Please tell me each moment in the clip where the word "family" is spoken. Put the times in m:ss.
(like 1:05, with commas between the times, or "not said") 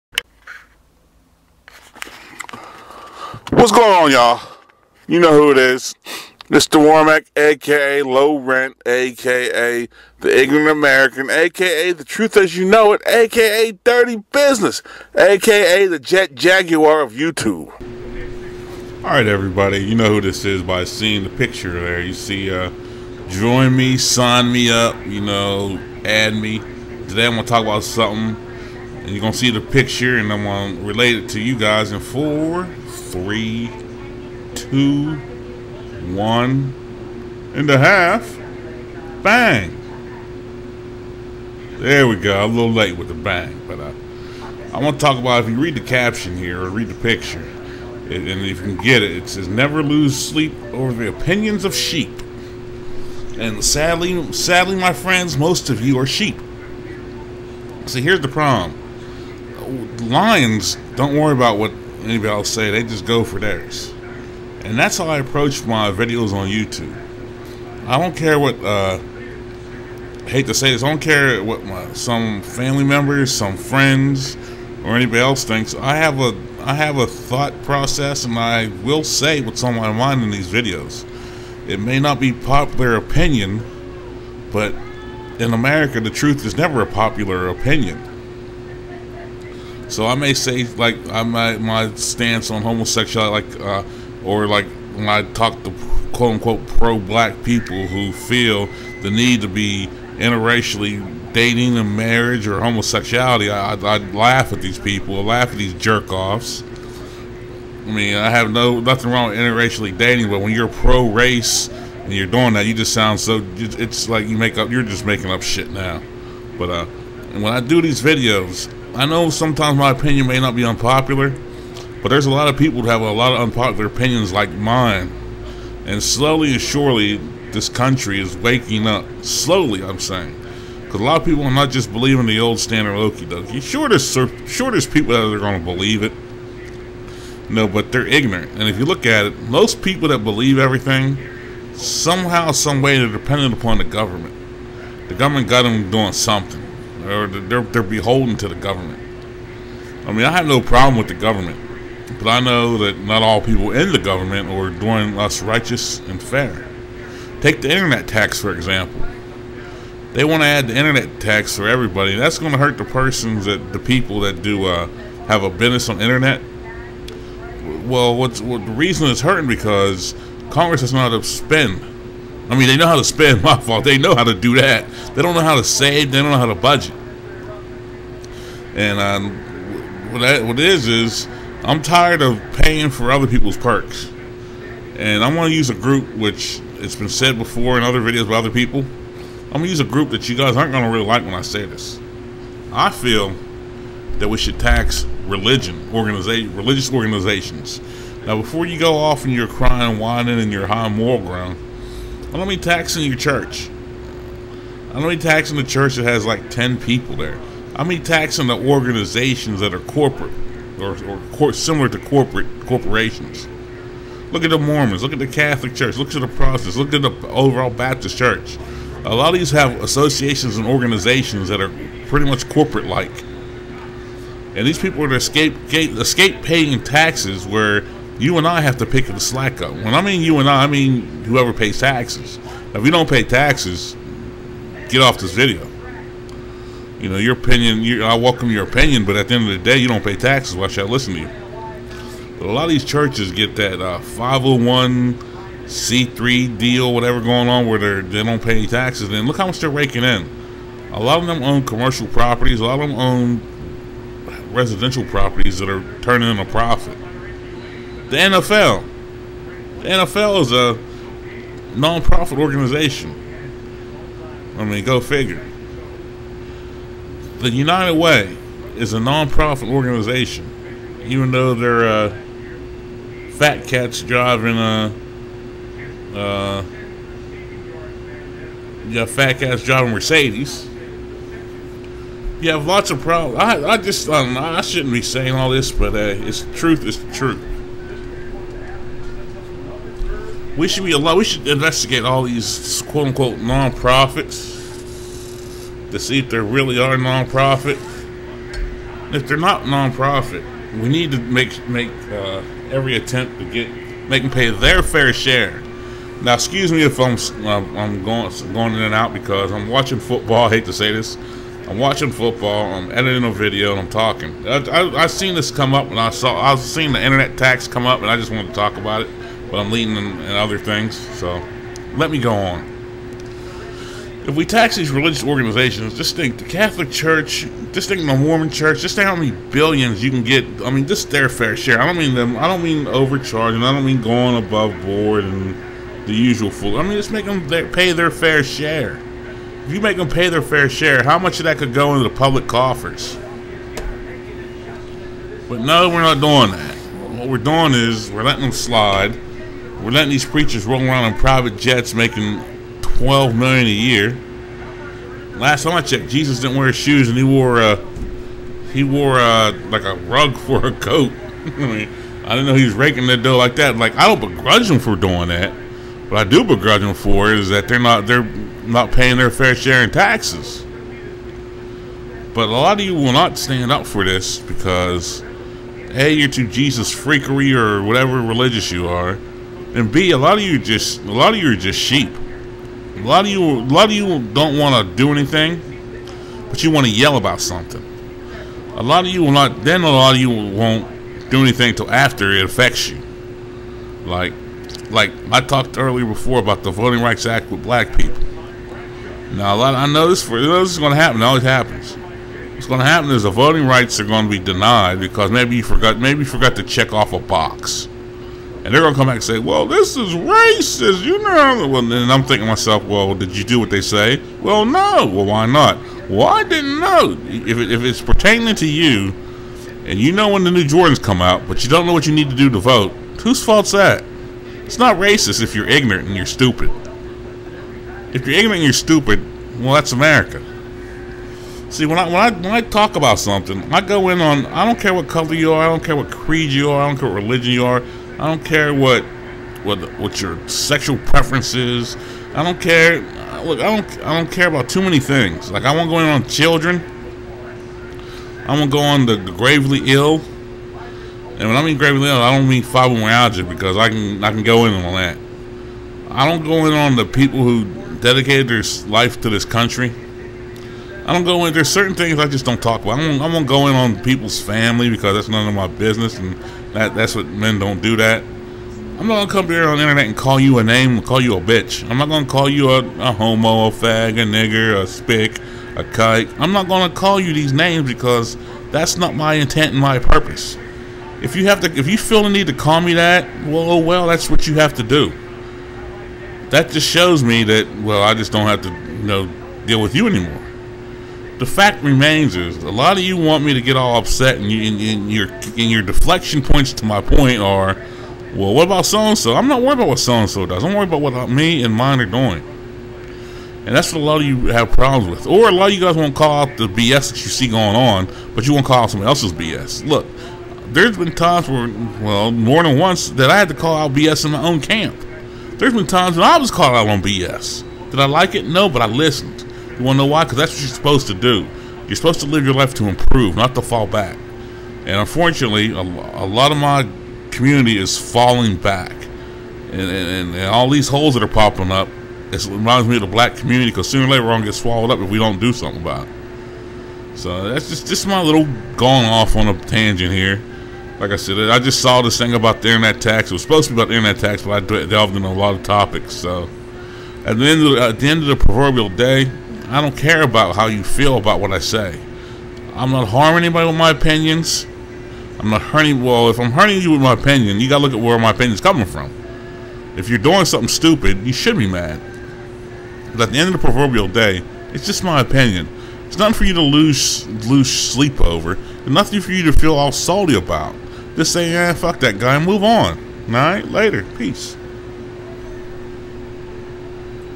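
1:12, 7:44.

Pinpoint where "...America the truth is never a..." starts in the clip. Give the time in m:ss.
1:25.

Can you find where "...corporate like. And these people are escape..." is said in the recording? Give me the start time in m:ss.
3:42.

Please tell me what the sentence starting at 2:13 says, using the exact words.
Sure, sure, there's people that are going to believe it.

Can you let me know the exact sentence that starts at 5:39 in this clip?
If you make them pay their fair share, how much of that could go into the public coffers?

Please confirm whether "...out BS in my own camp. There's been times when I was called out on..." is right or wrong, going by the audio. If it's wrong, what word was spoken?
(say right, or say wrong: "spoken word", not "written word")
right.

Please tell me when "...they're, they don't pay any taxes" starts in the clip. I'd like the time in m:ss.
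4:07.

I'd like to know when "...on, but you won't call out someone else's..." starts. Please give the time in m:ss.
8:27.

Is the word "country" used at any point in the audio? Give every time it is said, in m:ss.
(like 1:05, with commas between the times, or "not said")
2:07, 7:39.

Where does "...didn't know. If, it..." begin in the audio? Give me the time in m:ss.
6:56.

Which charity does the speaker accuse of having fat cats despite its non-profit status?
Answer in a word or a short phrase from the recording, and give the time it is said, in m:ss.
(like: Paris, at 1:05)
United Way, at 4:27.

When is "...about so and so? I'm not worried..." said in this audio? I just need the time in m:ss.
8:18.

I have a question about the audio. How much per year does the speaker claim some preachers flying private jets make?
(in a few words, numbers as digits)
12 million.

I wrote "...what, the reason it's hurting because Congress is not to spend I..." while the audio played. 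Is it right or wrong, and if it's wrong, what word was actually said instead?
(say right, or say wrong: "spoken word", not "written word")
right.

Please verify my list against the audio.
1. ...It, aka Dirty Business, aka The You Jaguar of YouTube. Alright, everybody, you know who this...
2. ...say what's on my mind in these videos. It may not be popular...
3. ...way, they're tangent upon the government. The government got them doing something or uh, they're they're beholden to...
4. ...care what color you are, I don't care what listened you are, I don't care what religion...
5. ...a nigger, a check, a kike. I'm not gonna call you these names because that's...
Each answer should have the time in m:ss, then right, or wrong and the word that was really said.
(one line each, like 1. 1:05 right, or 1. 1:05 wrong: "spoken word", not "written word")
1. 0:12 wrong: "Jet", not "You"
2. 1:19 right
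3. 2:22 wrong: "dependent", not "tangent"
4. 7:14 wrong: "creed", not "listened"
5. 7:54 wrong: "spick", not "check".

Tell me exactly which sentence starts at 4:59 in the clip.
If they're not non-profit, we need to make make uh, every attempt to get make them pay their fair share.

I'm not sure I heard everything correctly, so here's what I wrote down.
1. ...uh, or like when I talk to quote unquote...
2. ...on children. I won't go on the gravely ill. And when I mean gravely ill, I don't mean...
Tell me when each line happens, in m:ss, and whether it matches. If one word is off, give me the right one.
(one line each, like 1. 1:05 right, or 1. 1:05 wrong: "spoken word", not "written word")
1. 1:33 right
2. 7:26 right.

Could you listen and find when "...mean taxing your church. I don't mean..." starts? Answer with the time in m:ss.
3:22.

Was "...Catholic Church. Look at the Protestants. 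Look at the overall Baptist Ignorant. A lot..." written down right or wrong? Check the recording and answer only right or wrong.
wrong.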